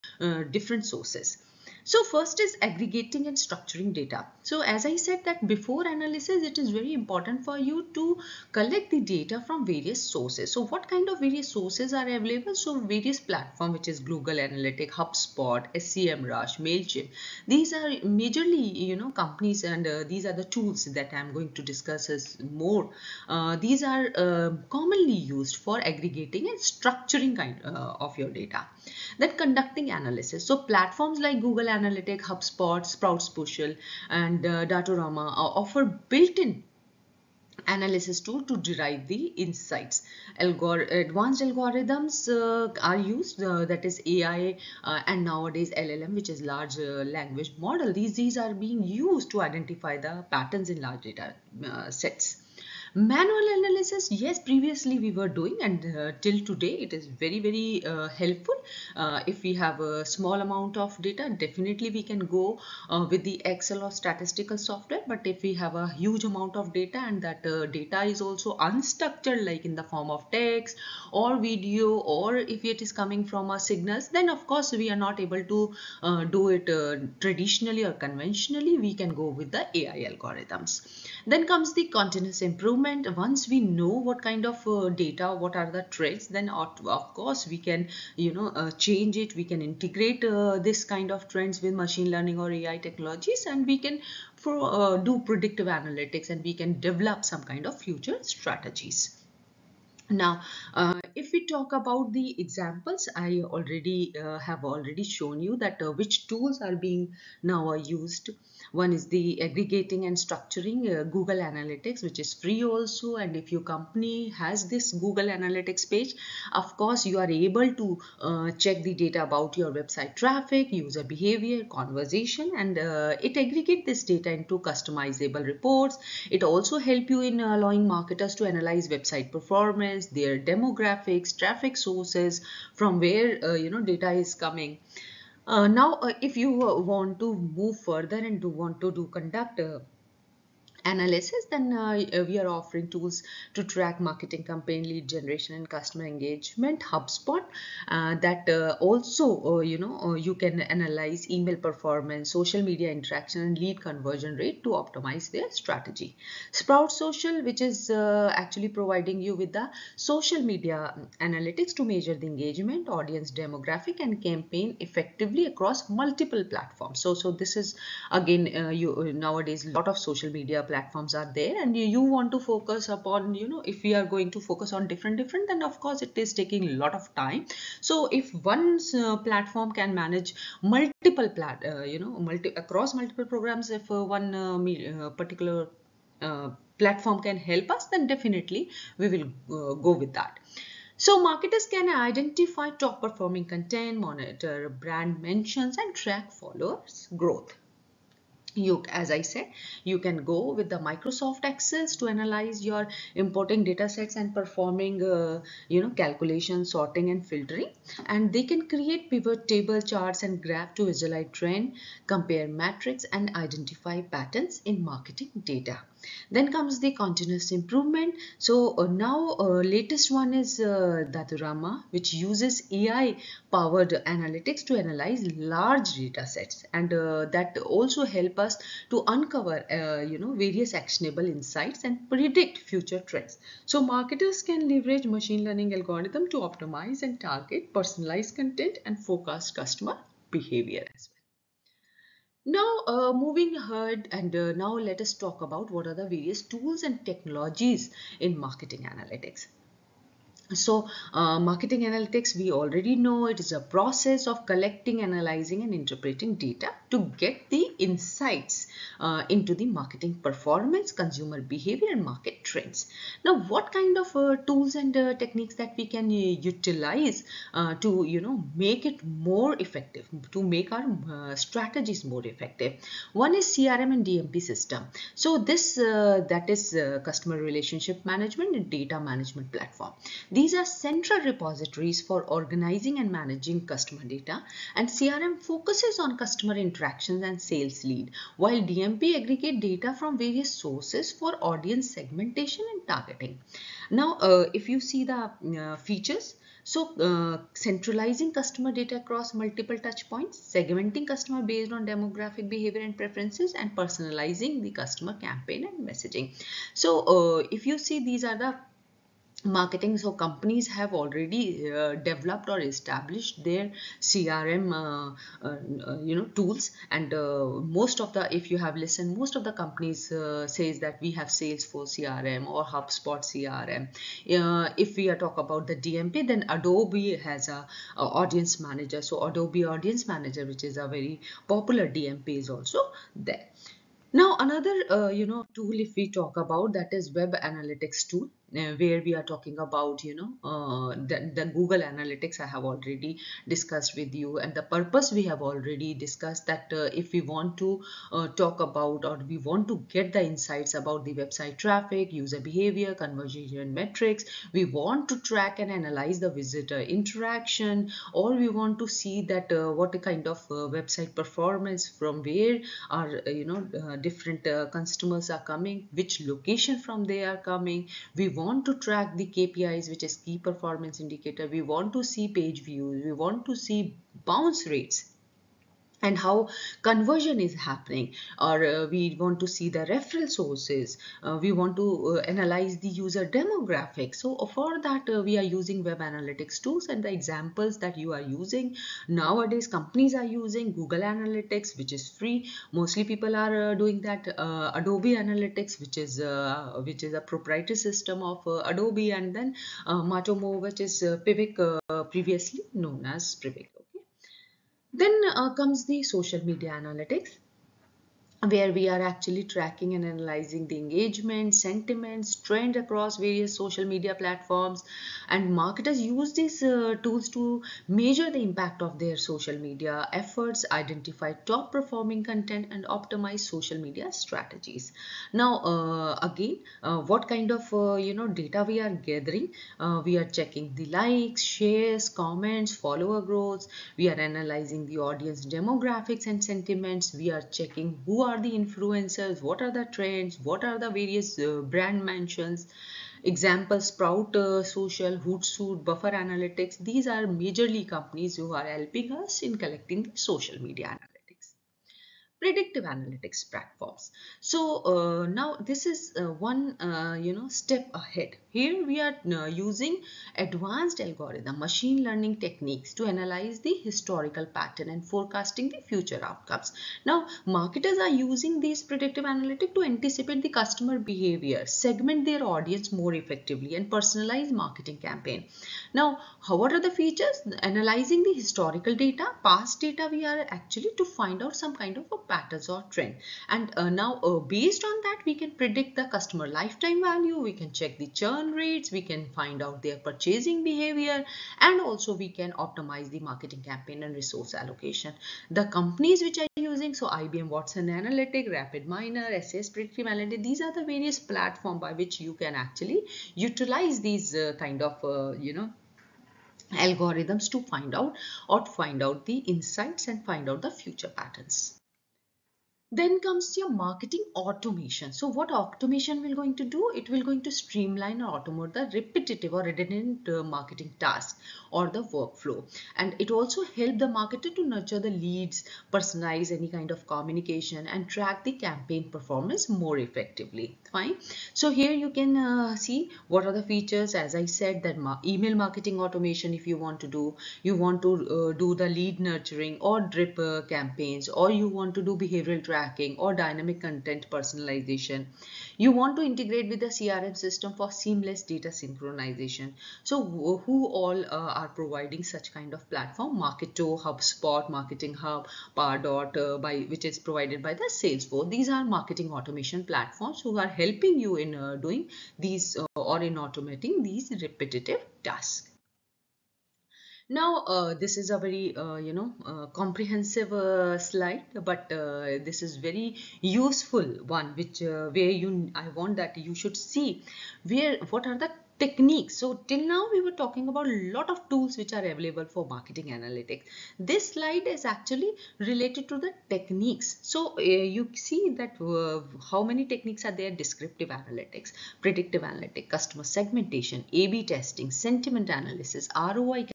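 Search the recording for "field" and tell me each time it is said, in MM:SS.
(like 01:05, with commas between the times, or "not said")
not said.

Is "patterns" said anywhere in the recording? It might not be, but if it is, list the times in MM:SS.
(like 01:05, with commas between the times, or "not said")
00:50, 03:34, 07:44, 08:02, 08:31.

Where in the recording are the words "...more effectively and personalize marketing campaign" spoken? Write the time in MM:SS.
07:53.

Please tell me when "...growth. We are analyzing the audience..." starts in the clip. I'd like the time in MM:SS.
07:13.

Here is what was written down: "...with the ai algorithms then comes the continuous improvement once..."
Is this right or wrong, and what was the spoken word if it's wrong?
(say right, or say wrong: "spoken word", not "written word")
right.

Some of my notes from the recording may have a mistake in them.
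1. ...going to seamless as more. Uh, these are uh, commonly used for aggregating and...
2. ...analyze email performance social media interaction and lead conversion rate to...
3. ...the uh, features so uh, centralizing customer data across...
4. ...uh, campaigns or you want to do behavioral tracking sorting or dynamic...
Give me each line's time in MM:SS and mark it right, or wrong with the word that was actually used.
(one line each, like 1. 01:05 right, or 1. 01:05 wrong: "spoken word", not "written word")
1. 00:21 wrong: "discuss", not "seamless"
2. 02:30 right
3. 04:55 right
4. 09:00 wrong: "tracking", not "sorting".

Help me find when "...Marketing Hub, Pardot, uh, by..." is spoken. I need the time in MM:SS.
09:14.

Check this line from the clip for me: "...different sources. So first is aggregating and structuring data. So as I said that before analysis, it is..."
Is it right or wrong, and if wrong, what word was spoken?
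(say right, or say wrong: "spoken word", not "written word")
right.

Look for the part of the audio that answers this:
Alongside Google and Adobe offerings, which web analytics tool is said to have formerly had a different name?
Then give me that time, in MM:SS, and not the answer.
06:39.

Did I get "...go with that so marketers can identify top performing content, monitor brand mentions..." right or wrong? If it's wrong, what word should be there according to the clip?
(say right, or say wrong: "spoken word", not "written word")
right.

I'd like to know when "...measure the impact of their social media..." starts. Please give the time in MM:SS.
06:57.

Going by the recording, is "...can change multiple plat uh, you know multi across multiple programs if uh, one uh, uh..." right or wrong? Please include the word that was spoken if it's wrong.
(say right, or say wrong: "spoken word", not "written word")
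wrong: "manage", not "change".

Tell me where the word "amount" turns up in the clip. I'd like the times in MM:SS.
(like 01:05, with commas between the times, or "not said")
01:00, 01:06.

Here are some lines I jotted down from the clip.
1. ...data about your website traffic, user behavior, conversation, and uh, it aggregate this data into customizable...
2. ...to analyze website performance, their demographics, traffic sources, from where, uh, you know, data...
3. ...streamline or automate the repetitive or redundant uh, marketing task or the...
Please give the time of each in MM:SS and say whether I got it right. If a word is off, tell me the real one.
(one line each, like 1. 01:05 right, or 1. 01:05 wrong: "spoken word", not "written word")
1. 01:58 right
2. 02:08 right
3. 08:37 right.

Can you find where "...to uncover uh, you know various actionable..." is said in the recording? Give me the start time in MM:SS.
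03:48.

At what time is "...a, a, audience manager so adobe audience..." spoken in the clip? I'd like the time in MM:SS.
05:27.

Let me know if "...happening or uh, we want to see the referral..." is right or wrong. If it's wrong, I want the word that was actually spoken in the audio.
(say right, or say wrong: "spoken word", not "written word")
right.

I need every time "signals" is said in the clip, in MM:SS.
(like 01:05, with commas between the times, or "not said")
01:13.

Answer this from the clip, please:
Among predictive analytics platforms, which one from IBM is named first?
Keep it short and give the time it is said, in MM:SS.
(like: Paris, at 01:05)
IBM Watson Analytic, at 08:17.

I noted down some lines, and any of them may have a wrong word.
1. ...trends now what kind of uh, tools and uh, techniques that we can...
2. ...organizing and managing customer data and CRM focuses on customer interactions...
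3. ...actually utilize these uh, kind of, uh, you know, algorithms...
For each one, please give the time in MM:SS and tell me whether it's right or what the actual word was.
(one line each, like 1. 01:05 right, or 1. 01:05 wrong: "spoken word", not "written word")
1. 04:22 right
2. 04:42 right
3. 08:22 right.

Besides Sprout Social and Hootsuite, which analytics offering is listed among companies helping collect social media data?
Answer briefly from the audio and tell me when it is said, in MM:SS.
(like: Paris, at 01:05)
Buffer Analytics, at 07:25.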